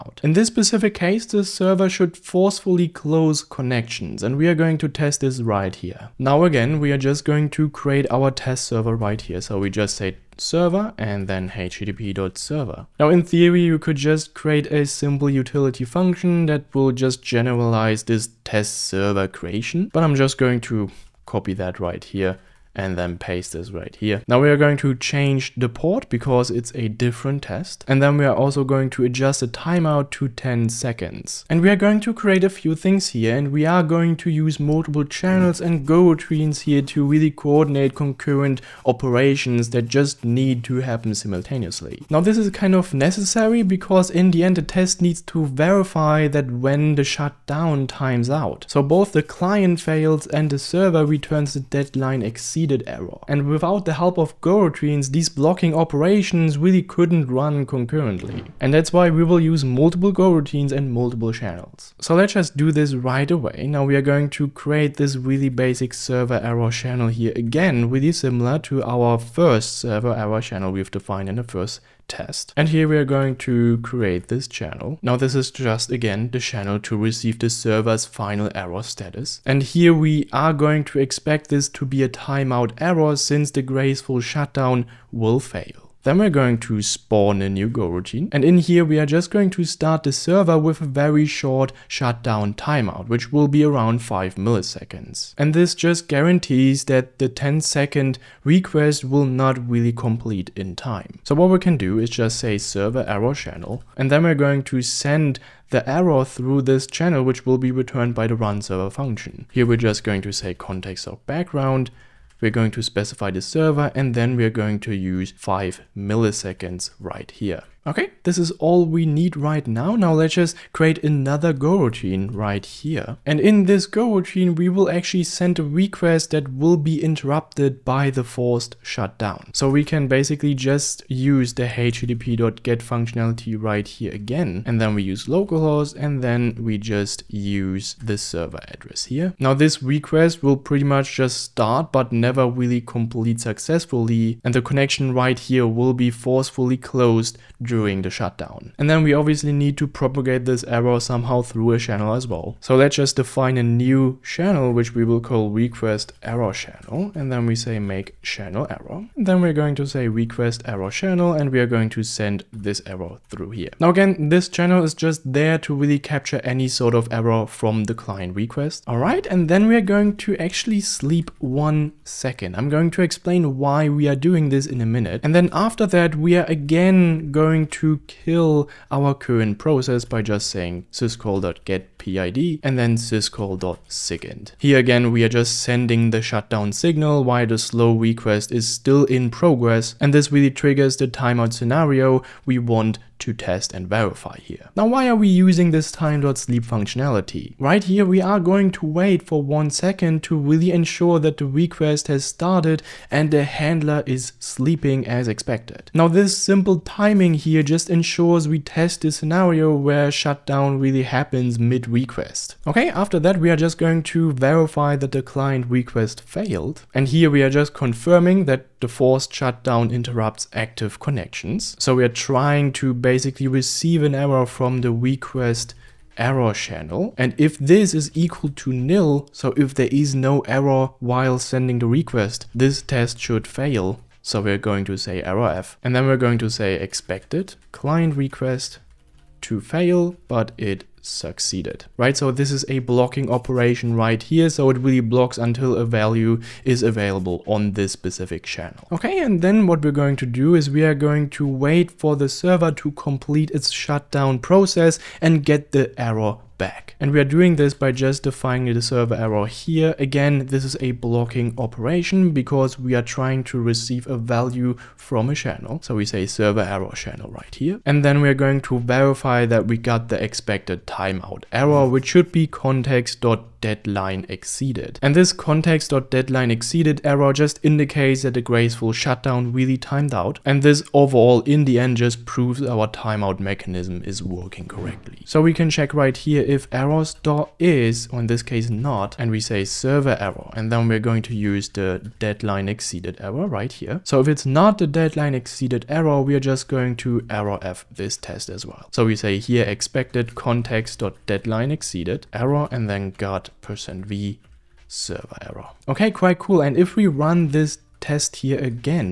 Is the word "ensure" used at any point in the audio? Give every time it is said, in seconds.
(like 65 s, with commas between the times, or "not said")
200 s, 207 s.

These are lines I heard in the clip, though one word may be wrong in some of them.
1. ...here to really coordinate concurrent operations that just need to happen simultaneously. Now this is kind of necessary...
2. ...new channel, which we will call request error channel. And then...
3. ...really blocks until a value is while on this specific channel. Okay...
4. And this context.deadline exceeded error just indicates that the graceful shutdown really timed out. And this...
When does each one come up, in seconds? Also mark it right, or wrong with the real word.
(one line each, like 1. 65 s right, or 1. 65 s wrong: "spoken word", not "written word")
1. 36 s right
2. 153 s right
3. 244 s wrong: "available", not "while"
4. 275 s right.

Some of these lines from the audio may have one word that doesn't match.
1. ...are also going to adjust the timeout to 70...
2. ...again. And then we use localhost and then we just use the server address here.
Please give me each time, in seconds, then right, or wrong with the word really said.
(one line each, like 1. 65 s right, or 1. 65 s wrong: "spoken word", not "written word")
1. 28 s wrong: "10", not "70"
2. 134 s right.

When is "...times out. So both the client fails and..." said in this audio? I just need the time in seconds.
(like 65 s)
47 s.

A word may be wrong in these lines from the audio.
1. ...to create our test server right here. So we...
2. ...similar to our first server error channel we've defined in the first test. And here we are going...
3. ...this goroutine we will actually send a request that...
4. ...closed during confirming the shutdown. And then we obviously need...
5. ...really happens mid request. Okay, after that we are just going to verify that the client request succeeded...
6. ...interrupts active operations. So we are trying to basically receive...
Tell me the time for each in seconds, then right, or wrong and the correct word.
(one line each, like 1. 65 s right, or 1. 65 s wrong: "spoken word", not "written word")
1. 7 s right
2. 68 s right
3. 123 s right
4. 146 s wrong: "during", not "confirming"
5. 210 s wrong: "failed", not "succeeded"
6. 219 s wrong: "connections", not "operations".